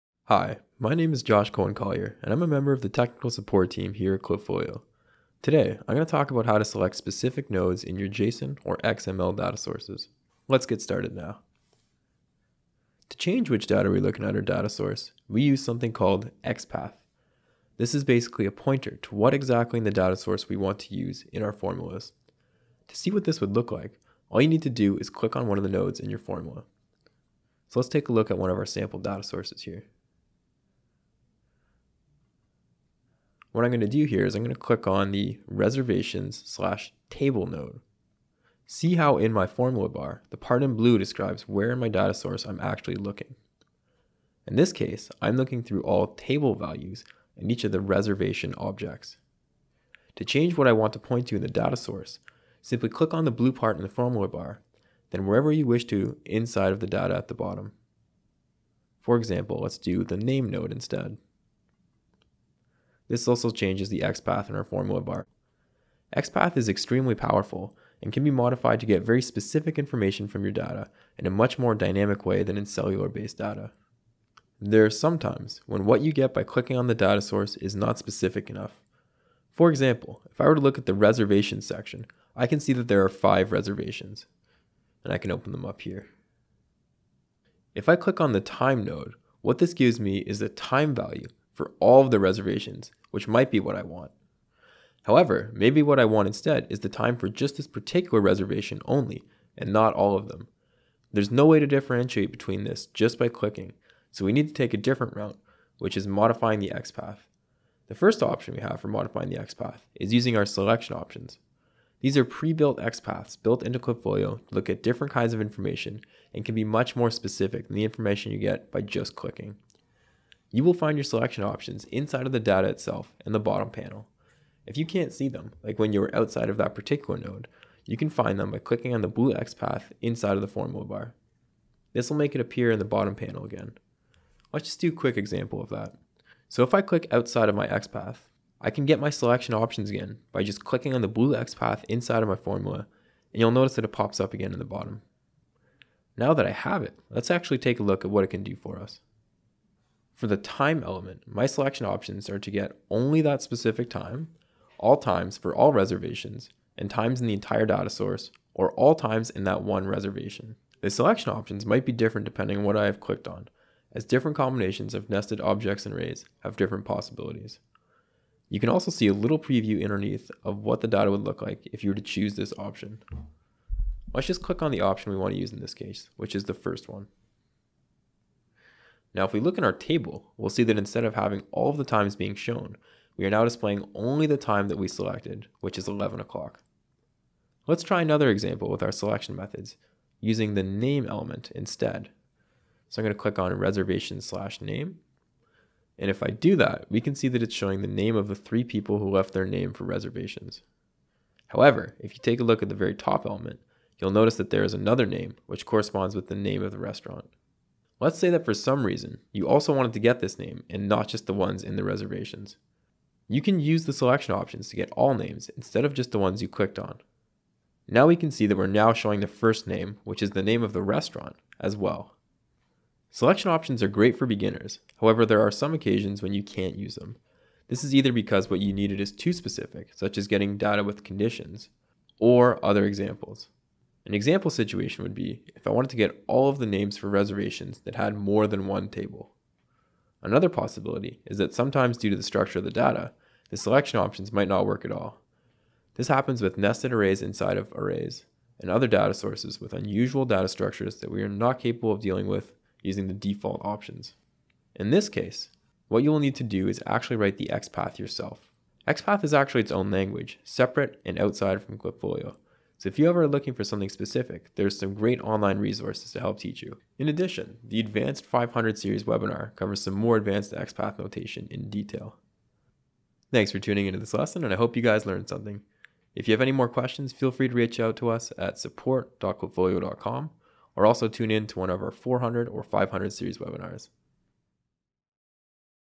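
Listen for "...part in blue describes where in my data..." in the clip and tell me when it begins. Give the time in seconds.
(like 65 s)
40 s.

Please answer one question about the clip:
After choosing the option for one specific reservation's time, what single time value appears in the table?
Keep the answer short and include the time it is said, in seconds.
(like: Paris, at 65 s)
11 o'clock, at 185 s.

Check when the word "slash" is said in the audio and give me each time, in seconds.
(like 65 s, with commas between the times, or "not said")
36 s, 194 s.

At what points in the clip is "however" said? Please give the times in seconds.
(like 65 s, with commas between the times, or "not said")
95 s, 201 s, 224 s.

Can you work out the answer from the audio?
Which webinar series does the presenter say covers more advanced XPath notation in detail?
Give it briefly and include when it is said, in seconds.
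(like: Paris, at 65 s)
Advanced 500 Series, at 267 s.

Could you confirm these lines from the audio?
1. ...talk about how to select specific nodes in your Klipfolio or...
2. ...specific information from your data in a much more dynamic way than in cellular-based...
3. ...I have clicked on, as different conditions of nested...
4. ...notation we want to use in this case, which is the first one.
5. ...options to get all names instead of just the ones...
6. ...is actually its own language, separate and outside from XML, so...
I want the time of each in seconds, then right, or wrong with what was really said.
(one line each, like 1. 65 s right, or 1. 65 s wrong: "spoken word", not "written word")
1. 6 s wrong: "JSON", not "Klipfolio"
2. 69 s right
3. 162 s wrong: "combinations", not "conditions"
4. 174 s wrong: "option", not "notation"
5. 214 s right
6. 259 s wrong: "Klipfolio", not "XML".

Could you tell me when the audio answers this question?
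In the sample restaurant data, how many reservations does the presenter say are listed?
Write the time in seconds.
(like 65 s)
83 s.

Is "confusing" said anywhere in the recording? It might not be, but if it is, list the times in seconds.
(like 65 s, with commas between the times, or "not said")
not said.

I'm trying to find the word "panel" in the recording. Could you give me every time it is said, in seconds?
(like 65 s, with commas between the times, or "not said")
123 s, 133 s.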